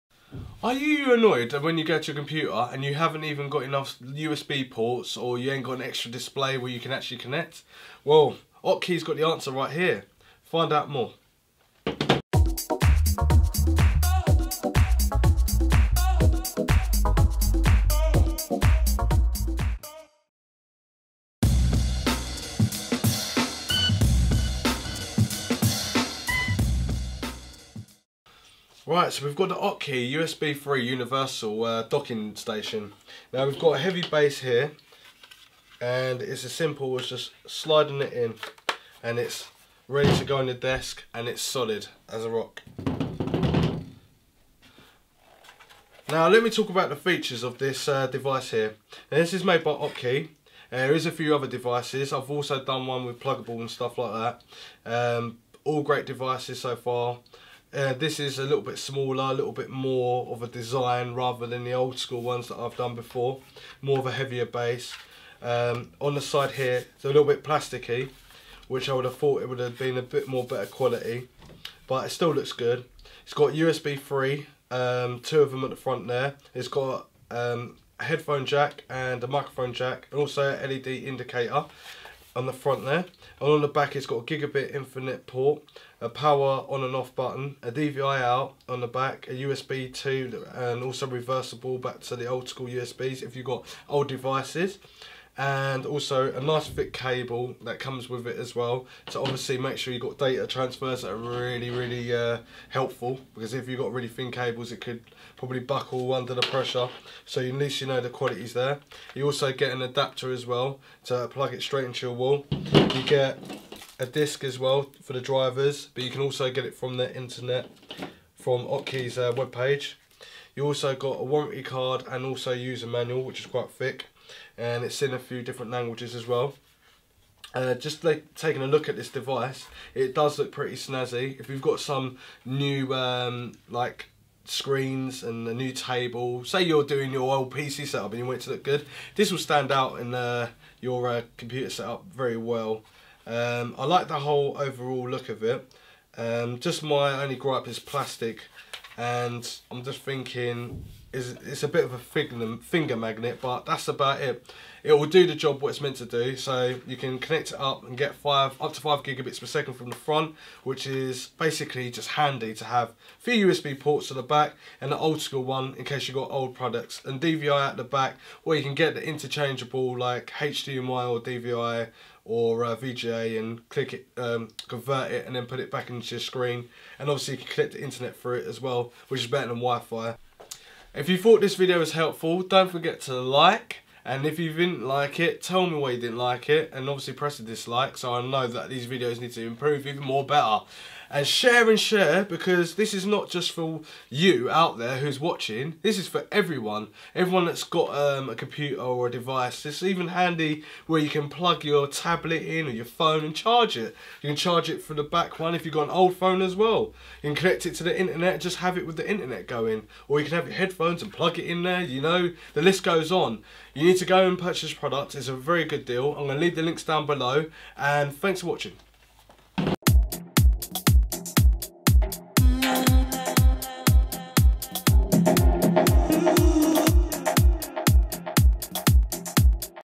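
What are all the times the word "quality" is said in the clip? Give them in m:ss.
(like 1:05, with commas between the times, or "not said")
1:10, 1:48.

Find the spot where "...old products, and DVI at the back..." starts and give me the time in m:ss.
2:46.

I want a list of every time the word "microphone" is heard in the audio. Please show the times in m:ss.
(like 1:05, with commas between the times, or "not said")
1:19.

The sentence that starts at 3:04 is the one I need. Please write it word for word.
And if you didn't like it, tell me why you didn't like it.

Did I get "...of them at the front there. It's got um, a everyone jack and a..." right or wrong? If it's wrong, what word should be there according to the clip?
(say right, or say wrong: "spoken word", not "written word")
wrong: "headphone", not "everyone".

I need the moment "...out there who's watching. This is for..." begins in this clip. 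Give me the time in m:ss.
3:14.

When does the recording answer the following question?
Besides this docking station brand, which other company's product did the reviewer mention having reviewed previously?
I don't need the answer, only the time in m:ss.
0:53.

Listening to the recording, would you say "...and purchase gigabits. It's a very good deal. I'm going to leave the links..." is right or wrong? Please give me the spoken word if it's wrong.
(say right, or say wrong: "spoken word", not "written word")
wrong: "products", not "gigabits".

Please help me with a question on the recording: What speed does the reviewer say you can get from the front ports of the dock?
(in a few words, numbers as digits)
5 gigabits per second.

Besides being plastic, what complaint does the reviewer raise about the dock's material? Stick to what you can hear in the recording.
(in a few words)
Finger magnet.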